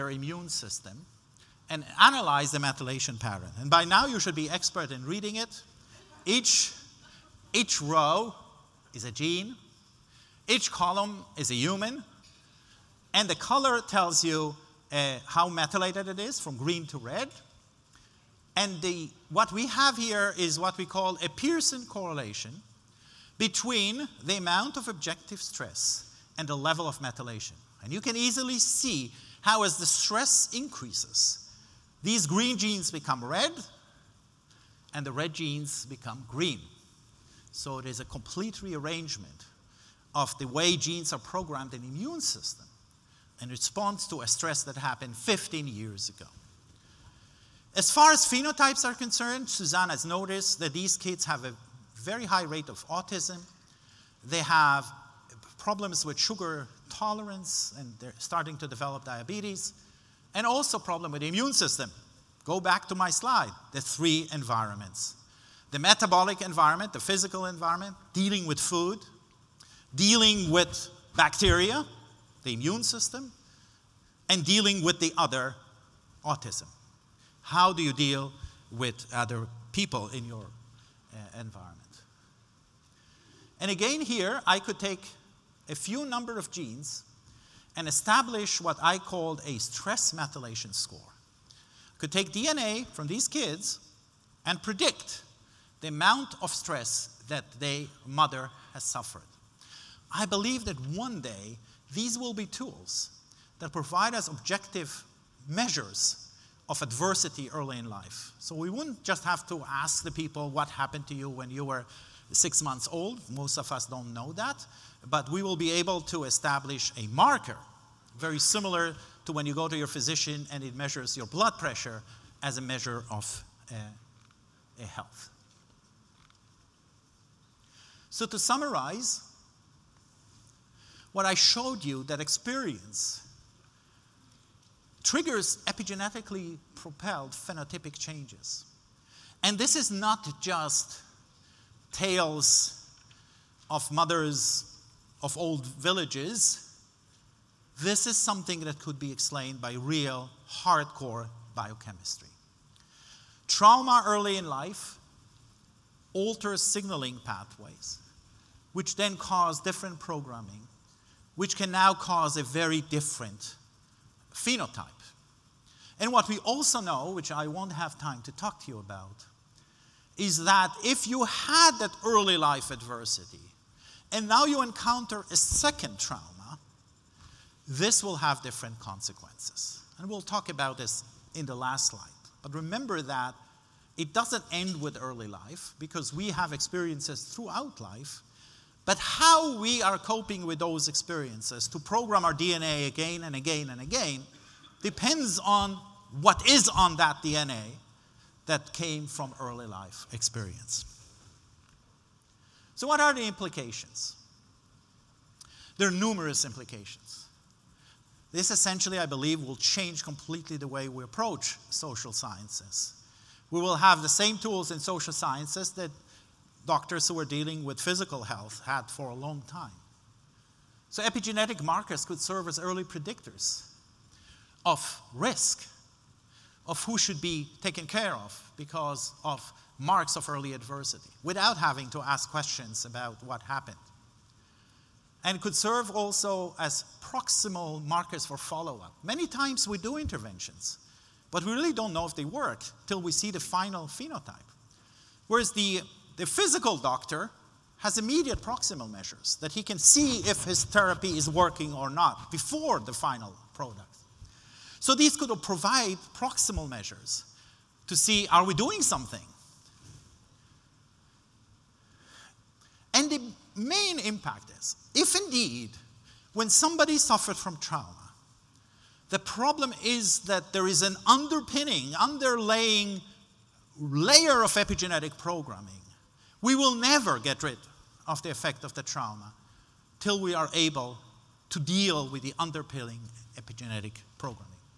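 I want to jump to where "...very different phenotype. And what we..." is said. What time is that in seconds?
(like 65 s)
162 s.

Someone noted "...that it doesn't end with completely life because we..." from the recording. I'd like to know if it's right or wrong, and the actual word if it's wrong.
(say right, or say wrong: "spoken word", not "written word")
wrong: "early", not "completely".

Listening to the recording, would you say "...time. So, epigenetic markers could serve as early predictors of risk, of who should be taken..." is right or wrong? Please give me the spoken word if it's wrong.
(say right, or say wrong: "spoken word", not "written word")
right.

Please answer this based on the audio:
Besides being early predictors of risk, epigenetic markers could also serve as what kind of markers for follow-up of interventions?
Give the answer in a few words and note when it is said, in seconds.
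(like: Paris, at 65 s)
proximal markers, at 237 s.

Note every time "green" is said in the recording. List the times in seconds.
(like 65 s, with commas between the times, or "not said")
16 s, 32 s, 36 s.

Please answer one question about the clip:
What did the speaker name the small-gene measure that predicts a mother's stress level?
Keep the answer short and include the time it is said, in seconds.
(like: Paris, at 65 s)
stress methylation score, at 89 s.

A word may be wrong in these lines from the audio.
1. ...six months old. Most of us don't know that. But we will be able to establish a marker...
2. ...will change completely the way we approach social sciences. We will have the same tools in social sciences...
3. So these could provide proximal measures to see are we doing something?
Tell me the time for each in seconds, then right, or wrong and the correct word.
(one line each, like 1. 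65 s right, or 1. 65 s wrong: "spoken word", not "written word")
1. 112 s right
2. 209 s right
3. 254 s right.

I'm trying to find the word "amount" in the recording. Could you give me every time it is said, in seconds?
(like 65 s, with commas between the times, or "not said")
24 s, 95 s.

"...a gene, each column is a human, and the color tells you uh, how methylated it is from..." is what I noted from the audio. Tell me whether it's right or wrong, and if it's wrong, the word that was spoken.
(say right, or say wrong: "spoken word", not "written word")
right.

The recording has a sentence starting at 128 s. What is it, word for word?
So, to summarize, what I showed you, that experience, triggers epigenetically propelled phenotypic changes.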